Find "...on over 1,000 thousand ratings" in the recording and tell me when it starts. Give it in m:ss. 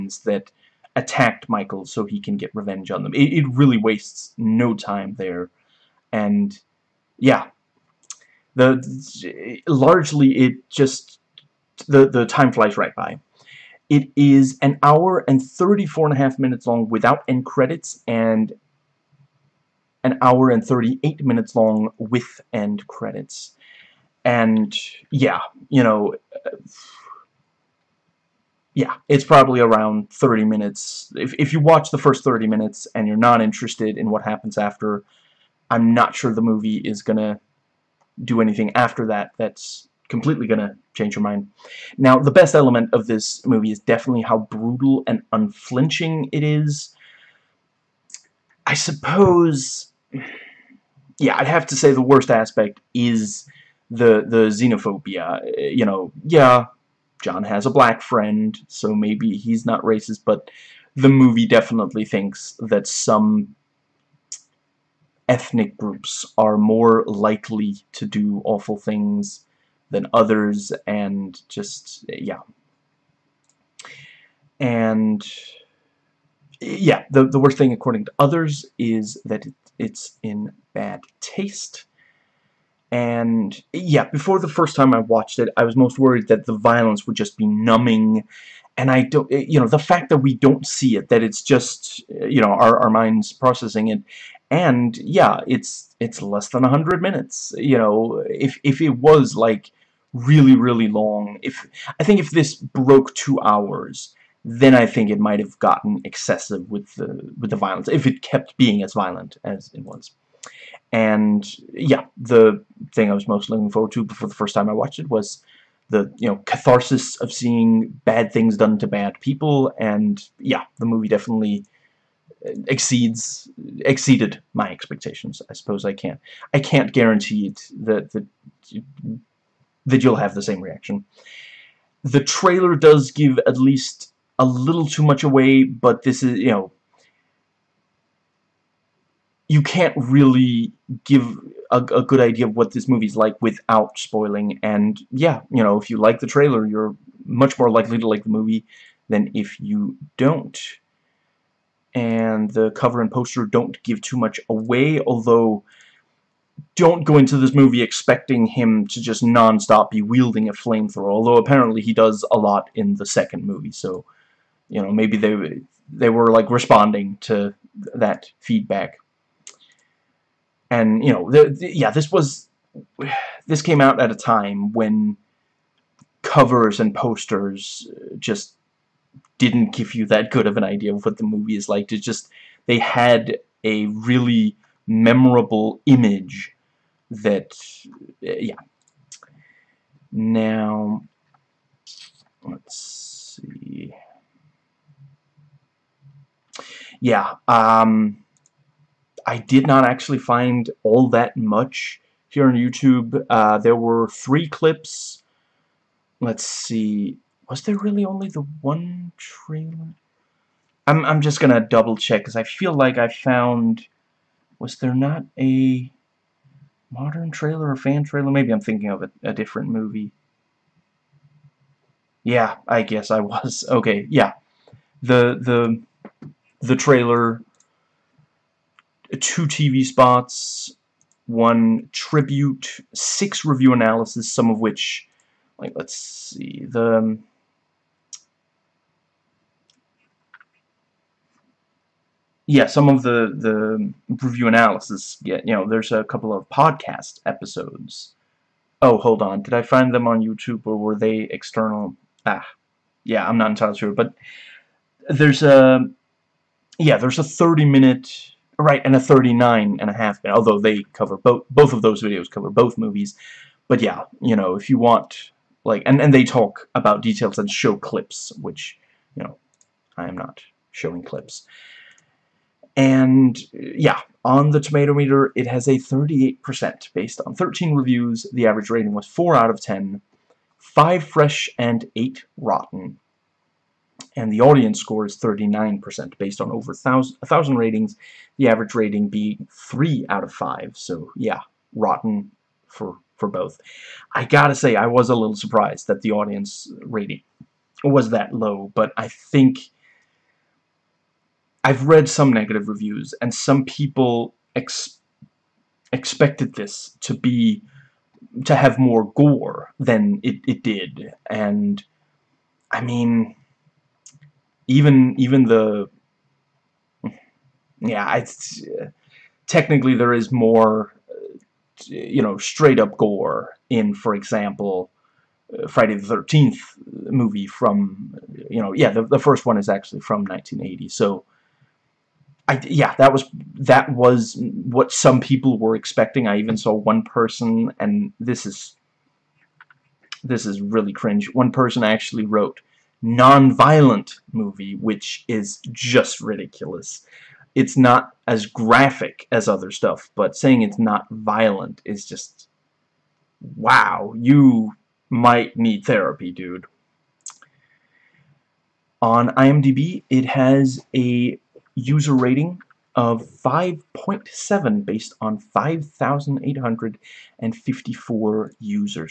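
4:46.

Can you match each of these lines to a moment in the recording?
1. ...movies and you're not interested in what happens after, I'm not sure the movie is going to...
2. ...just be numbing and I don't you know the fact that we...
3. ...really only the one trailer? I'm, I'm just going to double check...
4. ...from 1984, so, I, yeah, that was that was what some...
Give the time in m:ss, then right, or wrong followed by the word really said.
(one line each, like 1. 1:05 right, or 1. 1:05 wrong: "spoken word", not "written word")
1. 0:32 wrong: "minutes", not "movies"
2. 1:27 right
3. 3:27 right
4. 5:29 wrong: "1980", not "1984".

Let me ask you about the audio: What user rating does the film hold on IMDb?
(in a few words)
5.7.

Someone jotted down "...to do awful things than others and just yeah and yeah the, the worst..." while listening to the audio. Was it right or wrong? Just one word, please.
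right.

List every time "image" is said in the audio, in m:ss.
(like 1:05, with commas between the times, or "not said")
3:05.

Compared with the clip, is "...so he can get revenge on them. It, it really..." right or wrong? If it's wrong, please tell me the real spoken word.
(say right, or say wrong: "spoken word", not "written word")
right.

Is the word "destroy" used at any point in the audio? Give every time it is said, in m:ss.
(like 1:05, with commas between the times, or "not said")
not said.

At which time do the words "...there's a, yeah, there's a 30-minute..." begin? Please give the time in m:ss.
4:15.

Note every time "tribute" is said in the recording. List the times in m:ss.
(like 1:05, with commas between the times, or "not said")
3:51.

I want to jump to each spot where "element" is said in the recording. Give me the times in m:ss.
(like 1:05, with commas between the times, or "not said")
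0:42.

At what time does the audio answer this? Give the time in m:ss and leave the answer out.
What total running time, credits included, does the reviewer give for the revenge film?
0:20.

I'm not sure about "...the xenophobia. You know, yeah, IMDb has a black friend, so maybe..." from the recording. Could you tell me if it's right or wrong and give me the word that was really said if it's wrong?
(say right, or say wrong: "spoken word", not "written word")
wrong: "John", not "IMDb".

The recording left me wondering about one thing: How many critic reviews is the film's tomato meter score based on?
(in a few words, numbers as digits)
13.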